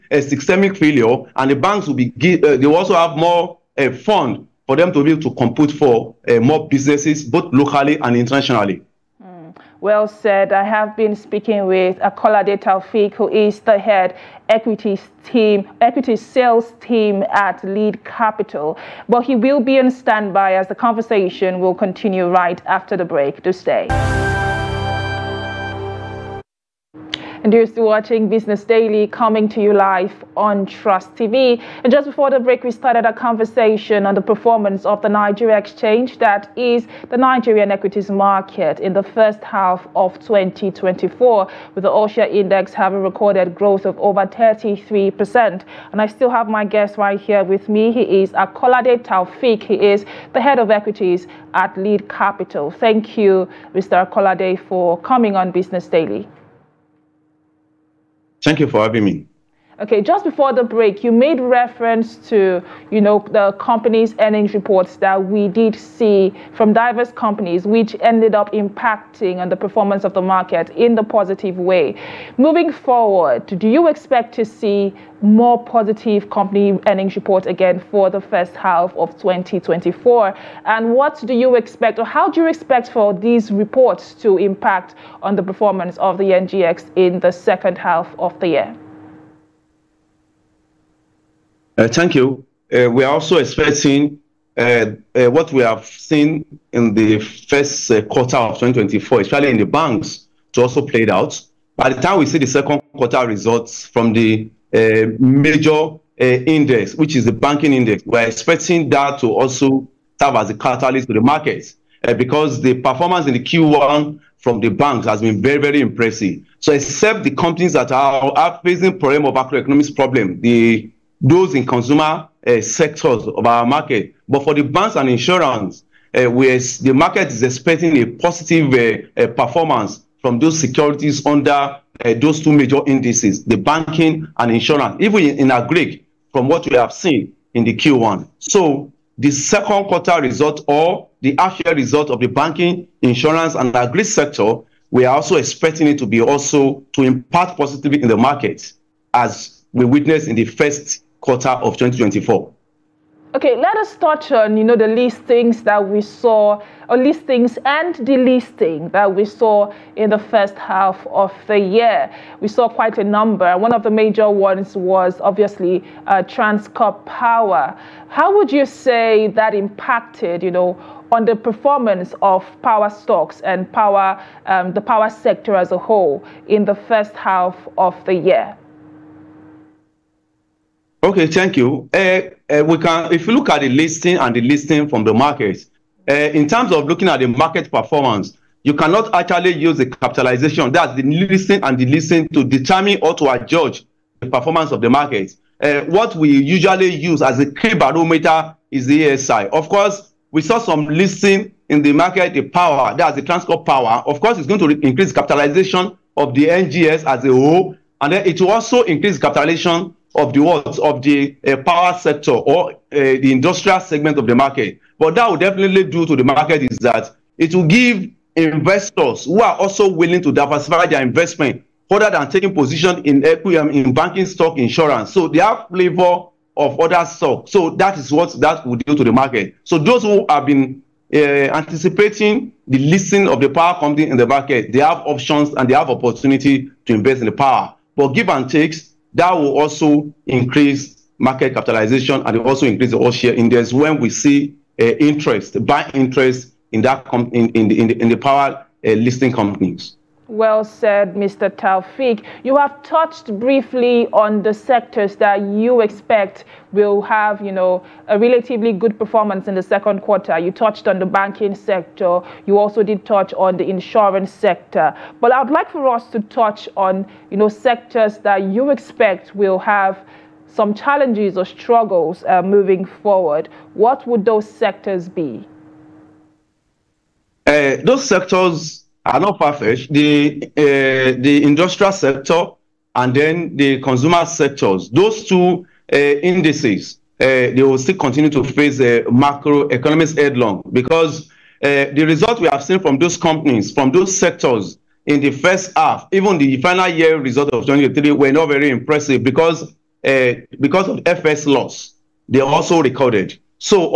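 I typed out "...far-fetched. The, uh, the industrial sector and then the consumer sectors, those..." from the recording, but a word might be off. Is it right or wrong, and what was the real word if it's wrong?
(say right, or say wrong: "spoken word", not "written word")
right.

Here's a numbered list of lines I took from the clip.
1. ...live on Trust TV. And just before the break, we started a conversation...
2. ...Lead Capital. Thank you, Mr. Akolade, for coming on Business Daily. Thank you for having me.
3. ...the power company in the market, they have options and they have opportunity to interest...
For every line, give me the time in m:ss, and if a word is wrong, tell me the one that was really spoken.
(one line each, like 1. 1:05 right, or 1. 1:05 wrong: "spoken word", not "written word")
1. 0:29 right
2. 0:51 right
3. 3:53 wrong: "invest", not "interest".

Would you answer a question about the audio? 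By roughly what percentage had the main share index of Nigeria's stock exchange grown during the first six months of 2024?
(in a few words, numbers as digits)
over 33%.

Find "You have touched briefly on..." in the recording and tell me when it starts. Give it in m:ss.
4:12.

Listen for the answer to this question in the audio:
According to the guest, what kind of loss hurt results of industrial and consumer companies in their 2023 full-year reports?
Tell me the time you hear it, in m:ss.
5:01.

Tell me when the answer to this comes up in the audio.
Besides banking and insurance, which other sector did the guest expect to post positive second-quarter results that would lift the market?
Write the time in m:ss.
2:23.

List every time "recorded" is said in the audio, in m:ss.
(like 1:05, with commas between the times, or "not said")
0:43, 5:02.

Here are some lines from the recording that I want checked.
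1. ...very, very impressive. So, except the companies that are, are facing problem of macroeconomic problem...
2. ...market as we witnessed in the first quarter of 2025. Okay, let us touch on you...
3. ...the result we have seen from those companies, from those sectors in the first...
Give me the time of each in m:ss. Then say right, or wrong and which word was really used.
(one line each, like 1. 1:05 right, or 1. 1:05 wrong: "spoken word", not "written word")
1. 1:55 right
2. 2:28 wrong: "2024", not "2025"
3. 4:51 right.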